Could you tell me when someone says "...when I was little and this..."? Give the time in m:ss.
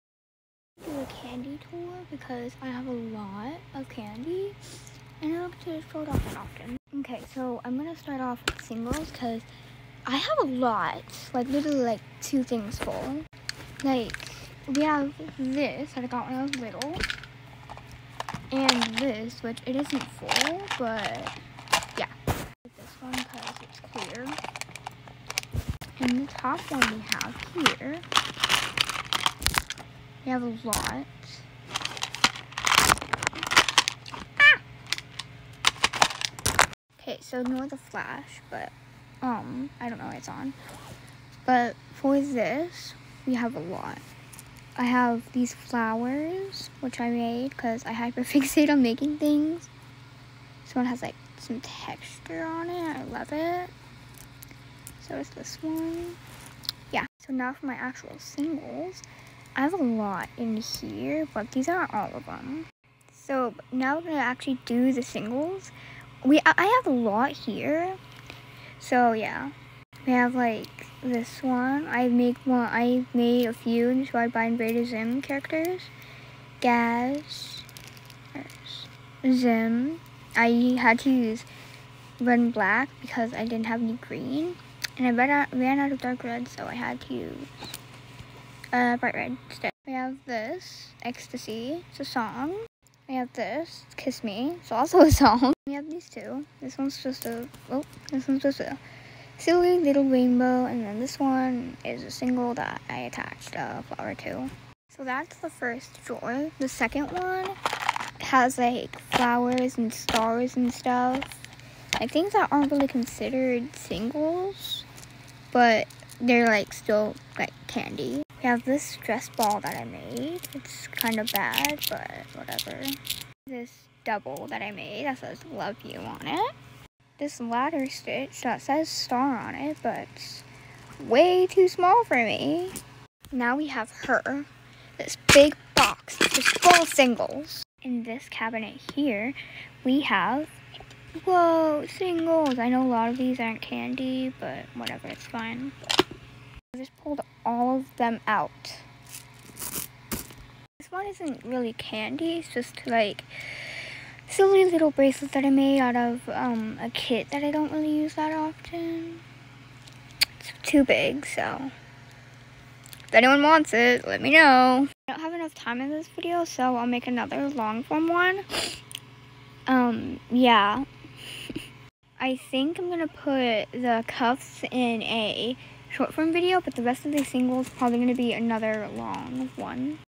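0:16.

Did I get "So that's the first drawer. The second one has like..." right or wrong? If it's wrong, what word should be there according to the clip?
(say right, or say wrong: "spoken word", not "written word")
right.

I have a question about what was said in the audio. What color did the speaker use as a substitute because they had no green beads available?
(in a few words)
bright red.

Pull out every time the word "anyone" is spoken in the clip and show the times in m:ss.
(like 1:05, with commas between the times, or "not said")
2:43.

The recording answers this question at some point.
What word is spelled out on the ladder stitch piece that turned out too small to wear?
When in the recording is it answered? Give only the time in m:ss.
2:08.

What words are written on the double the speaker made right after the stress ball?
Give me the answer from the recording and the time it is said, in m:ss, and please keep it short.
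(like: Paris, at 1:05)
love you, at 2:05.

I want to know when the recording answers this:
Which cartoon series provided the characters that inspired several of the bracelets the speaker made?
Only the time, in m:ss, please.
1:14.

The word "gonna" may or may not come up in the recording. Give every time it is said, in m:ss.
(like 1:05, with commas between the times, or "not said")
0:07, 1:04.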